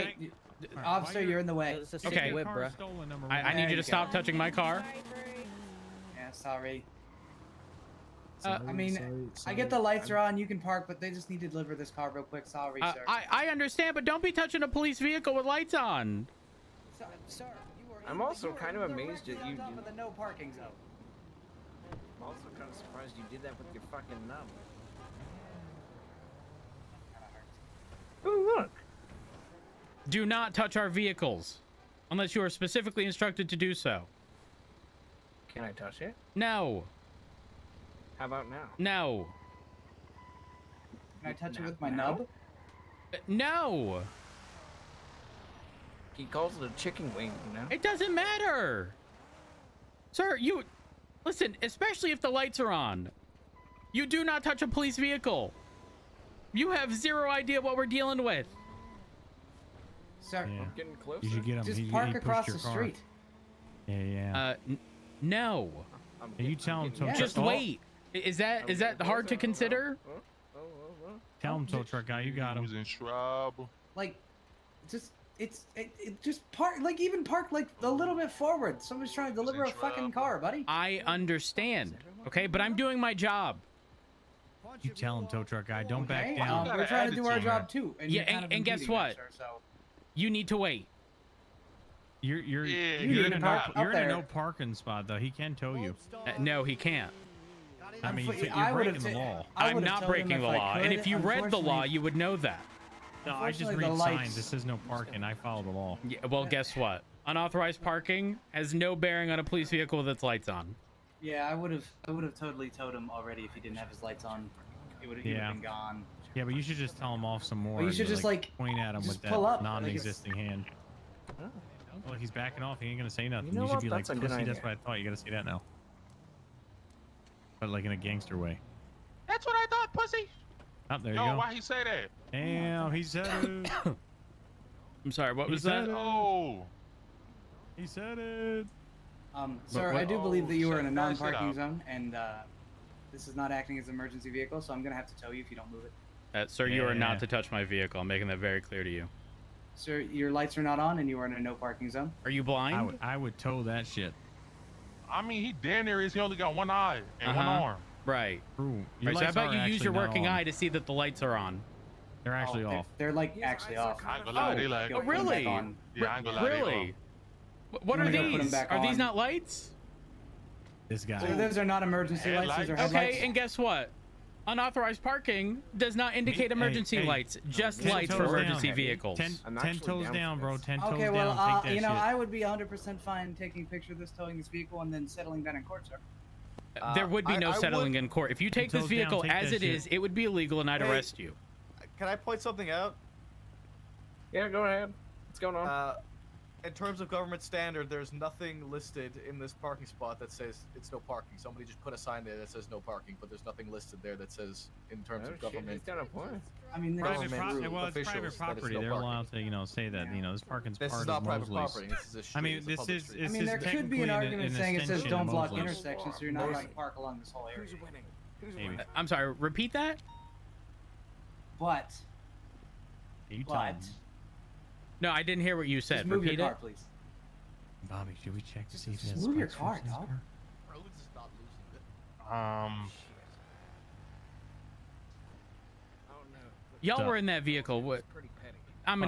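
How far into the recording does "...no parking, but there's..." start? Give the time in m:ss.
3:22.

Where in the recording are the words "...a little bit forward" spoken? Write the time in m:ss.
1:17.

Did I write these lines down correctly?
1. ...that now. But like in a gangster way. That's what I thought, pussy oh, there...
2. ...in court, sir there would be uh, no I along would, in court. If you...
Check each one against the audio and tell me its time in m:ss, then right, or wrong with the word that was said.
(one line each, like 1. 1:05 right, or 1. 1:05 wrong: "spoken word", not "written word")
1. 2:05 right
2. 3:05 wrong: "settling", not "along".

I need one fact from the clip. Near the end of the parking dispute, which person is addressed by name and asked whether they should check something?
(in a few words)
Bobby.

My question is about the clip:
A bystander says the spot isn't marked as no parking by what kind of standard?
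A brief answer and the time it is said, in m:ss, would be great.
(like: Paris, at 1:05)
government standard, at 3:17.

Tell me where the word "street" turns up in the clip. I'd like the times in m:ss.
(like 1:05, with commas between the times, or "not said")
1:02, 3:32.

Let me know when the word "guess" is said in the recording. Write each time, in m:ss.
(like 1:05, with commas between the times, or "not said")
1:28, 1:46, 2:53.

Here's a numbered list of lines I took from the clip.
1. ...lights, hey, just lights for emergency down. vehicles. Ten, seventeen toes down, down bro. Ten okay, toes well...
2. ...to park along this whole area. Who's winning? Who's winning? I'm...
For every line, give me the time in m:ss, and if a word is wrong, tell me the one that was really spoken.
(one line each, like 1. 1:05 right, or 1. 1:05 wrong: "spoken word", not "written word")
1. 2:57 wrong: "ten", not "seventeen"
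2. 3:36 right.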